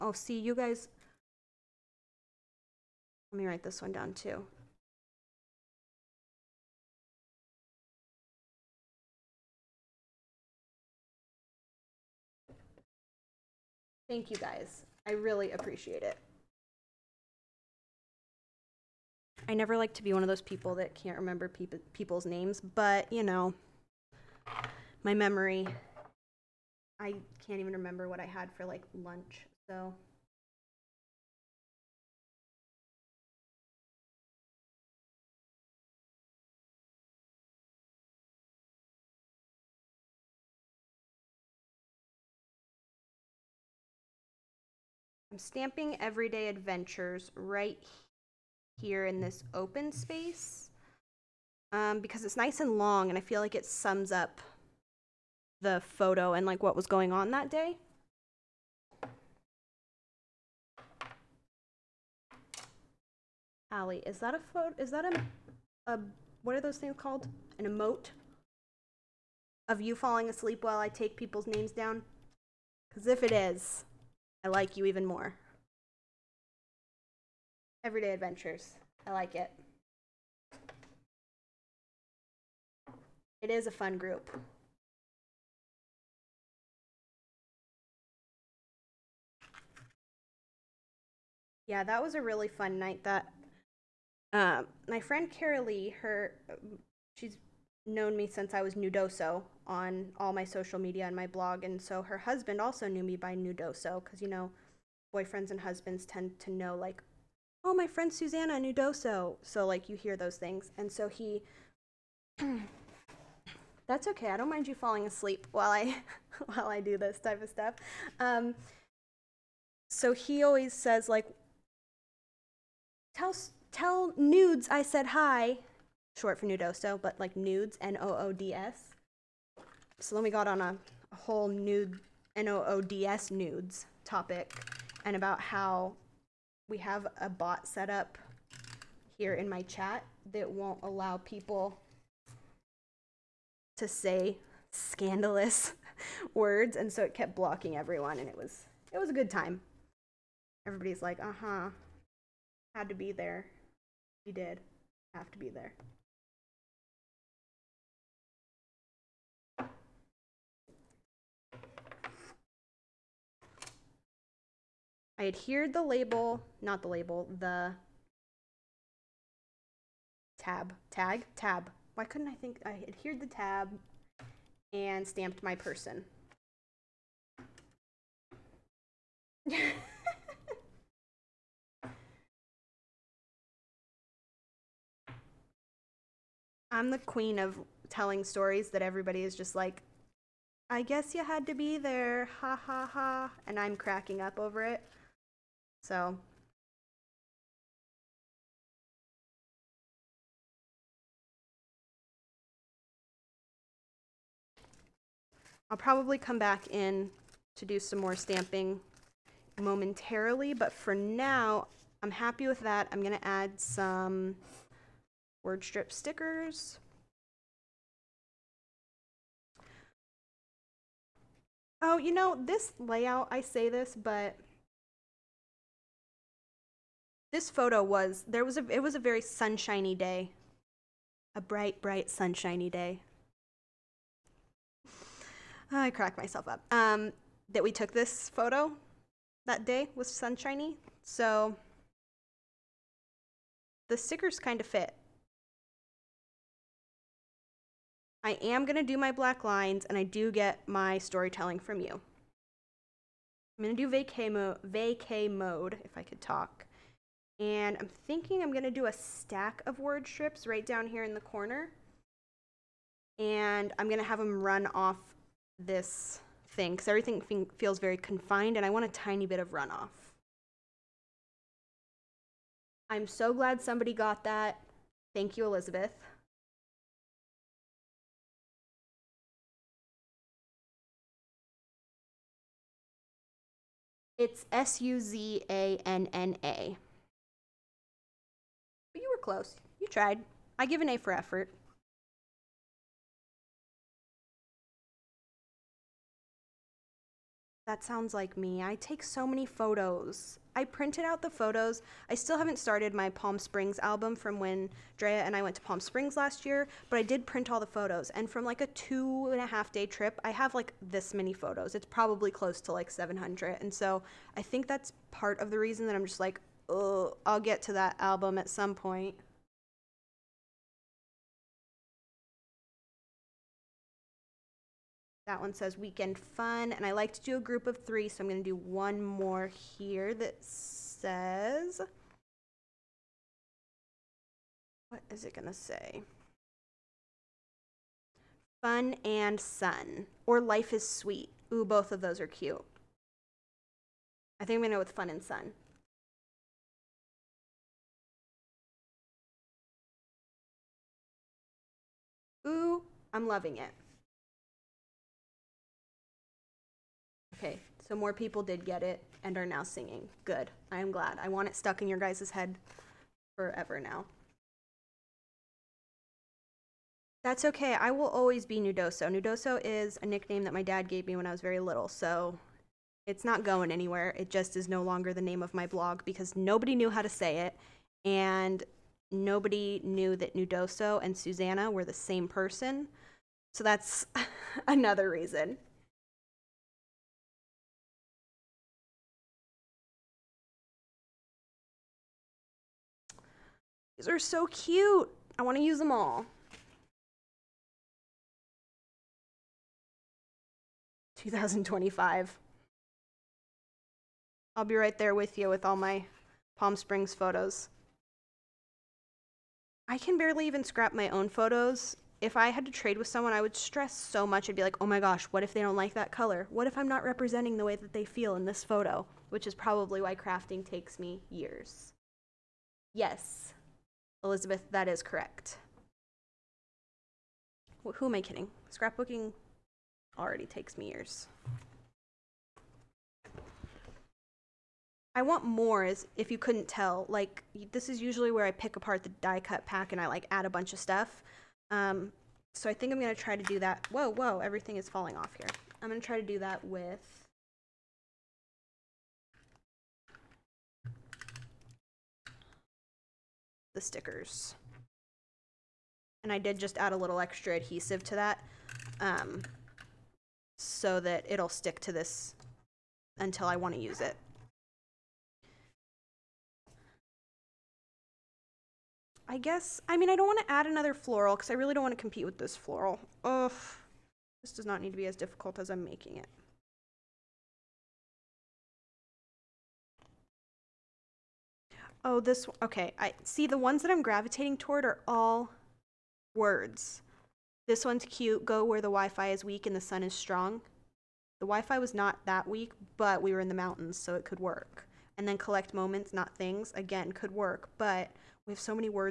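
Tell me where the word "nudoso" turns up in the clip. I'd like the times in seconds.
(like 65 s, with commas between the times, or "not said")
103 s, 108 s, 126 s.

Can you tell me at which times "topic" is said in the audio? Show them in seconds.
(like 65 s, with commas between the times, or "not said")
134 s.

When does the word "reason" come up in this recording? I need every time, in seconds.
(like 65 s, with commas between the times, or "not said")
315 s, 385 s.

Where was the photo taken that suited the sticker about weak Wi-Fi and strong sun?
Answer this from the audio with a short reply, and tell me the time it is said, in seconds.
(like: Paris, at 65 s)
the mountains, at 493 s.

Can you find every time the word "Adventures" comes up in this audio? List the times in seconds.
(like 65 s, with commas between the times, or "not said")
46 s, 78 s.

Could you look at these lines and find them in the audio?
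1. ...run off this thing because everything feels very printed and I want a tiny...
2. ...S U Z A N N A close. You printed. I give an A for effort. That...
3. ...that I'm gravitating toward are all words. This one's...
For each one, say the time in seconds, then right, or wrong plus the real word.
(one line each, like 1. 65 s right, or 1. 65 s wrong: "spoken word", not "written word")
1. 264 s wrong: "confined", not "printed"
2. 284 s wrong: "tried", not "printed"
3. 483 s right.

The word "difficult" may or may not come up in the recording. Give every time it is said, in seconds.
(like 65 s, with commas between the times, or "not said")
475 s.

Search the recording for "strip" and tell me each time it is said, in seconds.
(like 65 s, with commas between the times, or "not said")
215 s, 260 s.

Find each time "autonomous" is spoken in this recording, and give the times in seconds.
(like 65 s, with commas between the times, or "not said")
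not said.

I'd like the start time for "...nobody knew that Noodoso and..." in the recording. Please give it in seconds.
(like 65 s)
379 s.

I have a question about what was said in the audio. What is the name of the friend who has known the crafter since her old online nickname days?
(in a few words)
Carolee.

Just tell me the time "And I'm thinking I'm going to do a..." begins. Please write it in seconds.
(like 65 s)
257 s.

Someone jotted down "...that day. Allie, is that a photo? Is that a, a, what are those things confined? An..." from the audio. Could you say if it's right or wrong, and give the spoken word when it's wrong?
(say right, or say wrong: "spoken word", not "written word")
wrong: "called", not "confined".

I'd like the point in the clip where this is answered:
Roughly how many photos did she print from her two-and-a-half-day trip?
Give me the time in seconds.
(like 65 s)
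312 s.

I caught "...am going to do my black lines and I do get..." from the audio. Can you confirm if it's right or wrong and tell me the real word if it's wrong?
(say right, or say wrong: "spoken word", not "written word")
right.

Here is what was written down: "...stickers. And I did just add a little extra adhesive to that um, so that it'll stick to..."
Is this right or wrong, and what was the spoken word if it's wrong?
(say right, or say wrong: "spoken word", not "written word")
right.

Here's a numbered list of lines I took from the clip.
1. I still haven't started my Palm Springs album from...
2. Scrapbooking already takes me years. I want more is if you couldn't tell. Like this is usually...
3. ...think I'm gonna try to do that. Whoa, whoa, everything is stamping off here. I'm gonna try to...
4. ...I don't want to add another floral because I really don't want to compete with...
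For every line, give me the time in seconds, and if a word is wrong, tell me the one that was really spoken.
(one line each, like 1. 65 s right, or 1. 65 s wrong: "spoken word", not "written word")
1. 302 s right
2. 428 s right
3. 442 s wrong: "falling", not "stamping"
4. 470 s right.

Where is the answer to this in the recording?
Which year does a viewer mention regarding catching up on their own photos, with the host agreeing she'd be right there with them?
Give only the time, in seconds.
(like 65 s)
401 s.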